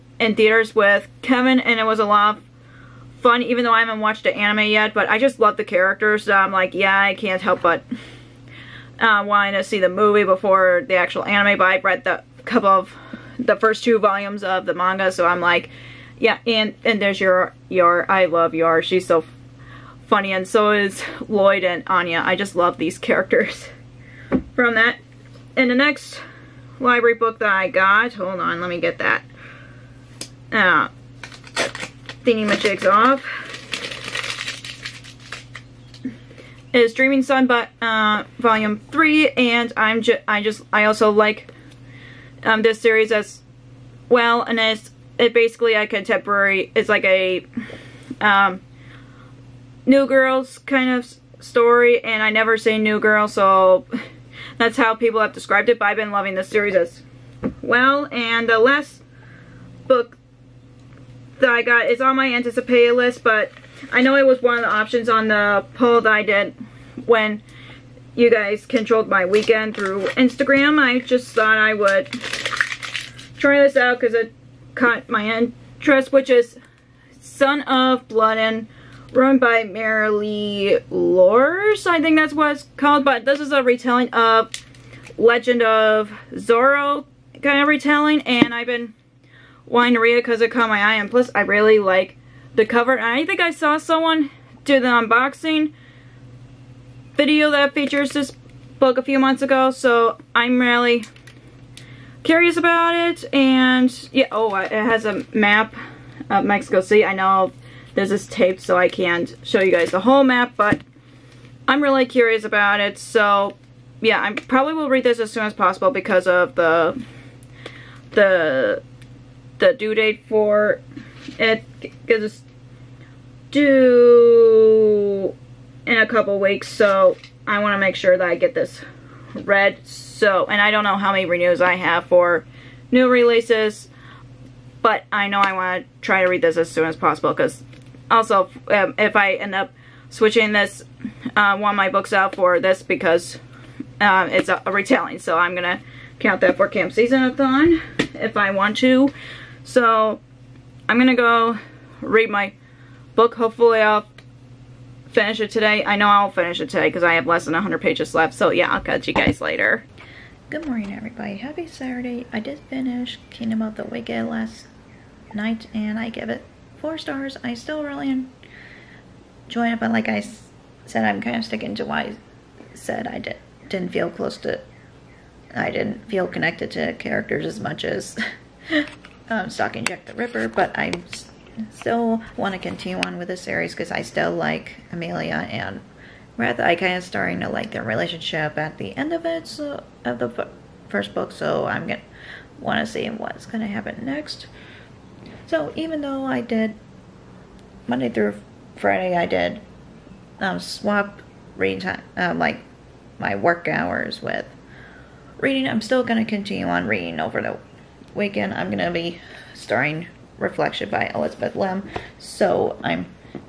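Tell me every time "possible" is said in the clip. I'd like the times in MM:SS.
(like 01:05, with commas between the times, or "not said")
01:55, 02:16.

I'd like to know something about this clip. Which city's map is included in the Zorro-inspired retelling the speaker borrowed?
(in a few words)
Mexico City.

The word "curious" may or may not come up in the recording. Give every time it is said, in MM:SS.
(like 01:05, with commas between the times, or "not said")
01:42, 01:52.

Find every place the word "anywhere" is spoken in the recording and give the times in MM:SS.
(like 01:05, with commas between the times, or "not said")
not said.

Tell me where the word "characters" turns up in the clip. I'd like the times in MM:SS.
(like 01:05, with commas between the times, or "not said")
00:05, 00:22, 02:56.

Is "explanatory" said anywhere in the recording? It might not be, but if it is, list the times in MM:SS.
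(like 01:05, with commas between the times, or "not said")
not said.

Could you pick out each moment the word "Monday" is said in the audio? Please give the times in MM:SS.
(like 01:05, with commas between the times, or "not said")
03:17.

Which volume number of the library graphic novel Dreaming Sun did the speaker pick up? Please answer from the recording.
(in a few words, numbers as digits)
3.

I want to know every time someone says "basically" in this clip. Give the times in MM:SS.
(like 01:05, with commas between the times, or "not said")
00:45.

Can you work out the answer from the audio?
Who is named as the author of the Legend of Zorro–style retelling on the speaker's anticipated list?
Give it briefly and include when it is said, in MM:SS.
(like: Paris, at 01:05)
Mariely Lares, at 01:19.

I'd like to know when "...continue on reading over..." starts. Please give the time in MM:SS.
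03:26.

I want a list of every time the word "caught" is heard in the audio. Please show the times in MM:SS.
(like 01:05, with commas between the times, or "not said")
01:14, 01:30.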